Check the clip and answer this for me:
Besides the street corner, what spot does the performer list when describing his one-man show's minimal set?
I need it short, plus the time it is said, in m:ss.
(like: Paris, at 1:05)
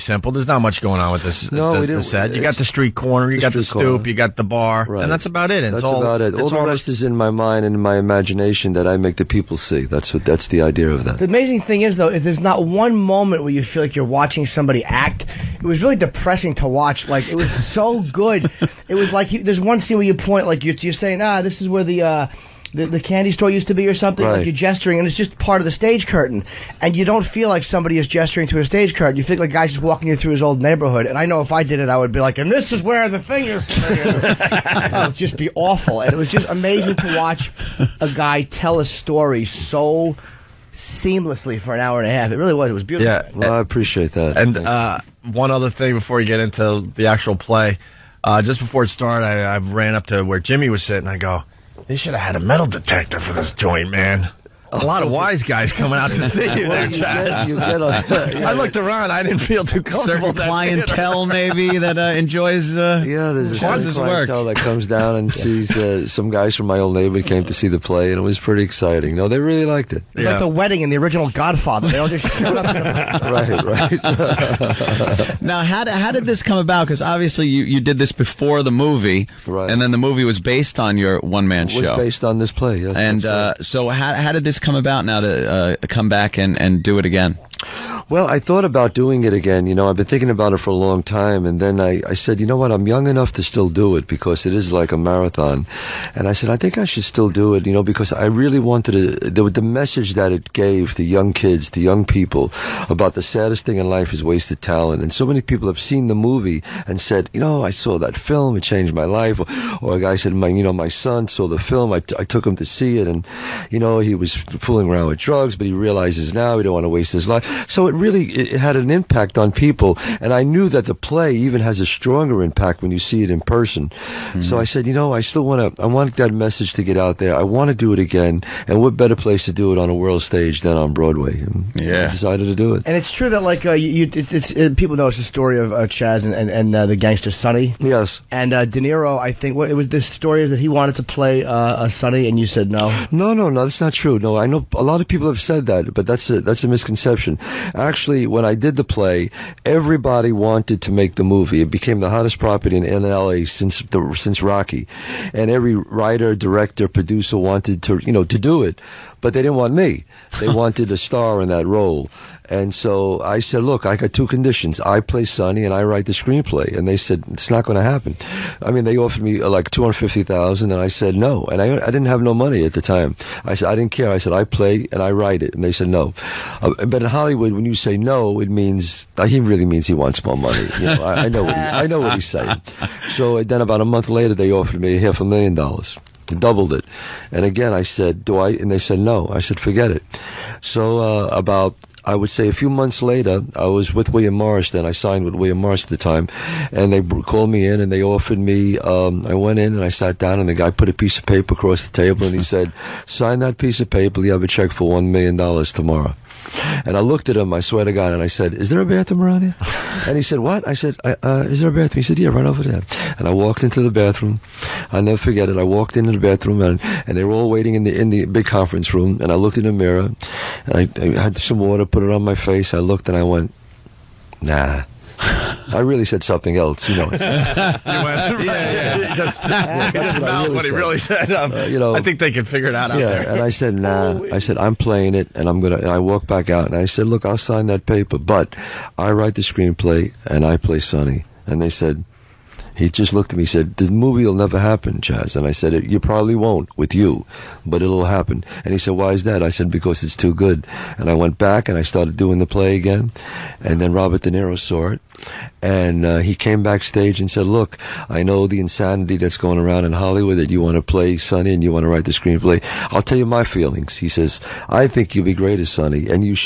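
The stoop, at 0:03.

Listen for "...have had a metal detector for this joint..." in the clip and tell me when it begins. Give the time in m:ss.
0:52.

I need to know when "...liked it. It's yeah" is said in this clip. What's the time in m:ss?
1:09.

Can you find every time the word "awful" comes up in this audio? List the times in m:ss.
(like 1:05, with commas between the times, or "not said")
0:35.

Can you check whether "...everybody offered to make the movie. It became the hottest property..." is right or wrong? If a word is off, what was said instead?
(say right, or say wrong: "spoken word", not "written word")
wrong: "wanted", not "offered".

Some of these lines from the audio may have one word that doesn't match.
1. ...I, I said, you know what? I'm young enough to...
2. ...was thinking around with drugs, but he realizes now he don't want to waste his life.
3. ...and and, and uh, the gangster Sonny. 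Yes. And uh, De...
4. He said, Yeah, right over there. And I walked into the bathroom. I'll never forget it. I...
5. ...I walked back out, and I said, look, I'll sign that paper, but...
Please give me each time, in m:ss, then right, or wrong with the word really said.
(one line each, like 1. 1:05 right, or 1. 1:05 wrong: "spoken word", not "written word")
1. 1:31 right
2. 1:54 wrong: "fooling", not "thinking"
3. 2:16 right
4. 3:32 right
5. 3:55 right.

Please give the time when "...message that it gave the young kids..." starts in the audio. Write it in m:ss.
1:39.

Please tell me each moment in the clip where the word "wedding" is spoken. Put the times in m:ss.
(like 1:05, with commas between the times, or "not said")
1:10.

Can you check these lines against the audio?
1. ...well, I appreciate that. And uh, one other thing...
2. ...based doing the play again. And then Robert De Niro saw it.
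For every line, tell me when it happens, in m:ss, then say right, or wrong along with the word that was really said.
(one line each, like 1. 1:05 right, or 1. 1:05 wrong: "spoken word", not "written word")
1. 0:43 right
2. 4:11 wrong: "started", not "based".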